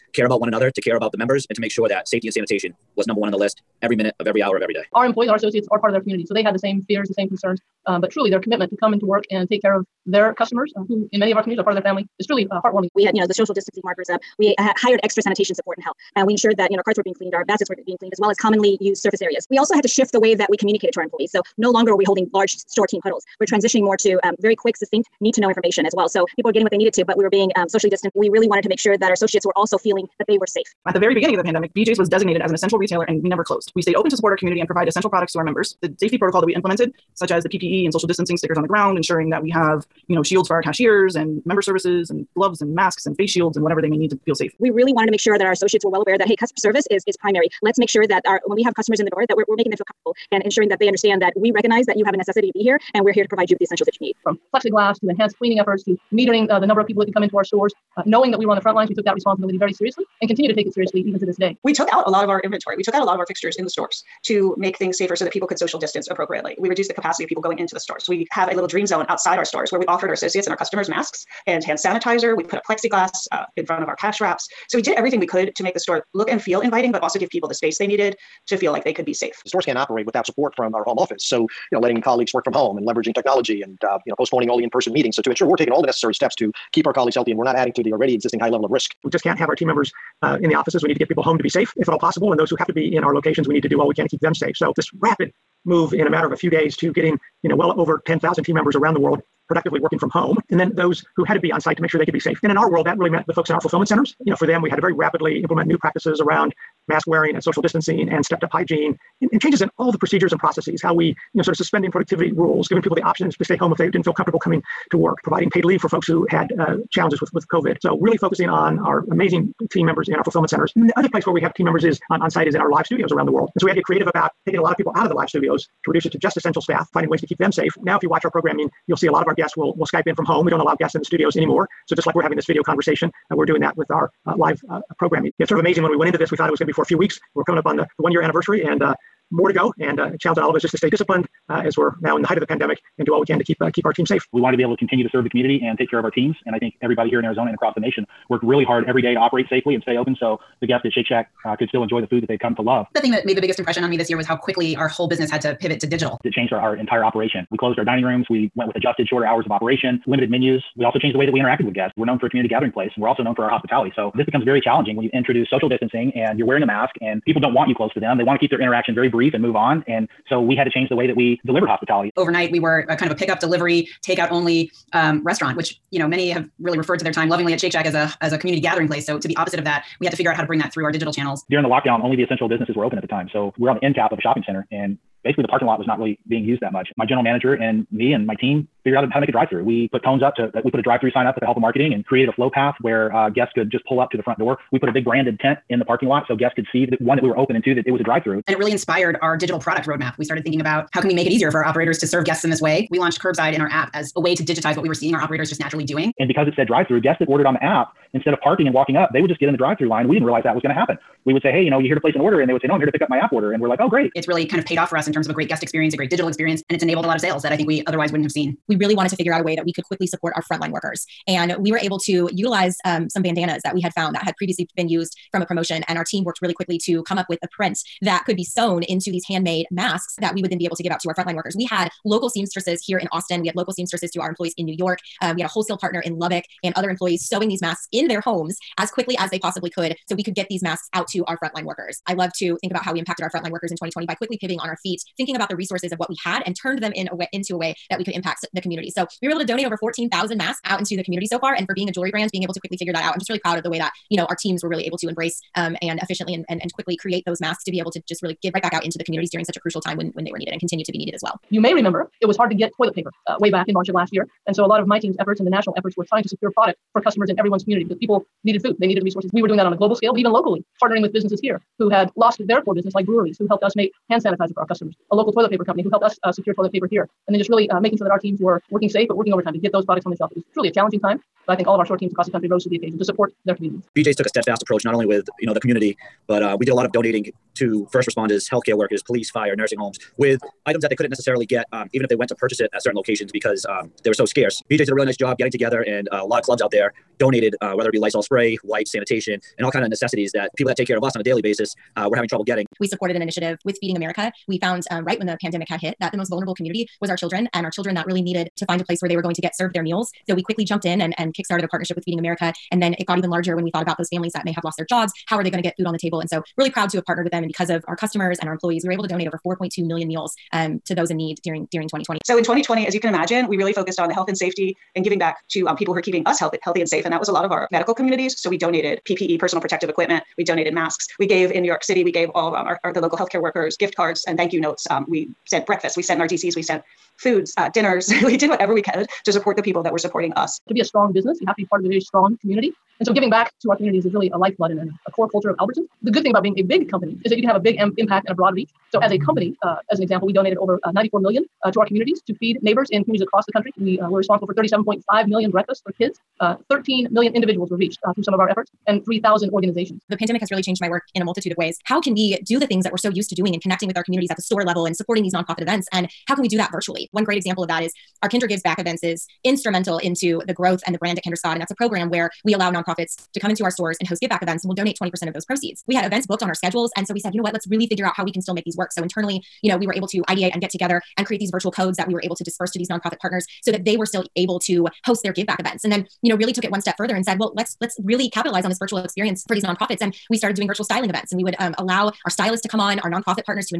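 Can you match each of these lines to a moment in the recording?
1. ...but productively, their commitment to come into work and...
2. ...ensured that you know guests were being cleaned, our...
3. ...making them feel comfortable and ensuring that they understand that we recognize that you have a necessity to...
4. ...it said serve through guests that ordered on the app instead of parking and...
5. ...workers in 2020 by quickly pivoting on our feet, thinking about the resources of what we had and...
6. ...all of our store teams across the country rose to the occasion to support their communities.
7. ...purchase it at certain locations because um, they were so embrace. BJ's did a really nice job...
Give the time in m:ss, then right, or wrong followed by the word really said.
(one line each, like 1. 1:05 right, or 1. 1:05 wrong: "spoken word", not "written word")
1. 0:08 wrong: "truly", not "productively"
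2. 0:16 wrong: "carts", not "guests"
3. 0:49 right
4. 3:26 wrong: "drive", not "serve"
5. 4:03 right
6. 4:41 right
7. 4:52 wrong: "scarce", not "embrace".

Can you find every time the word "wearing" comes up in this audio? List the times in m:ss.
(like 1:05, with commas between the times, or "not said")
1:47, 2:46.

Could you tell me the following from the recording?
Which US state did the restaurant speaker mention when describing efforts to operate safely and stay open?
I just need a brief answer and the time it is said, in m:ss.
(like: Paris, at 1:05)
Arizona, at 2:27.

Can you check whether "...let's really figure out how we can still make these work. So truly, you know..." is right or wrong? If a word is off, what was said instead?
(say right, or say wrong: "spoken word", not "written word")
wrong: "internally", not "truly".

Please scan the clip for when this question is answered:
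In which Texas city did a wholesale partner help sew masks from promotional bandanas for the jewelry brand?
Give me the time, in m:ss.
3:56.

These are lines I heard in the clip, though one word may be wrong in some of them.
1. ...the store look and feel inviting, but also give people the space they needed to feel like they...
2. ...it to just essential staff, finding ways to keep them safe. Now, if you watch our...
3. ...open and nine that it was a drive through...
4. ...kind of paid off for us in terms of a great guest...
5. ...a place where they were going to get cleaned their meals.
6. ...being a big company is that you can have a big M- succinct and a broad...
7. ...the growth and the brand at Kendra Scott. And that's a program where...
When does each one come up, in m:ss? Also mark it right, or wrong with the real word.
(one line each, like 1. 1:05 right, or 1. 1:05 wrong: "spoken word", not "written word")
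1. 1:15 right
2. 2:06 right
3. 3:17 wrong: "two", not "nine"
4. 3:34 right
5. 5:08 wrong: "served", not "cleaned"
6. 5:46 wrong: "impact", not "succinct"
7. 6:10 right.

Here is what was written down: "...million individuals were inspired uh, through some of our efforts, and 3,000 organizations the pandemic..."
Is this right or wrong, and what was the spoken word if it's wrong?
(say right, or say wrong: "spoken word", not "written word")
wrong: "reached", not "inspired".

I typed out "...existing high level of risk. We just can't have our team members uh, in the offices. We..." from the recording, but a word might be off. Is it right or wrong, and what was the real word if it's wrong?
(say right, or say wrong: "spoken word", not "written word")
right.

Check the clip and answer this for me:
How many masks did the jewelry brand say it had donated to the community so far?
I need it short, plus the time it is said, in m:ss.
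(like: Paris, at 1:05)
14,000, at 4:09.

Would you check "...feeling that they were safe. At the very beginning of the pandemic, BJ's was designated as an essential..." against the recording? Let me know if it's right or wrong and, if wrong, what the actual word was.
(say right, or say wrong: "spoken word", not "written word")
right.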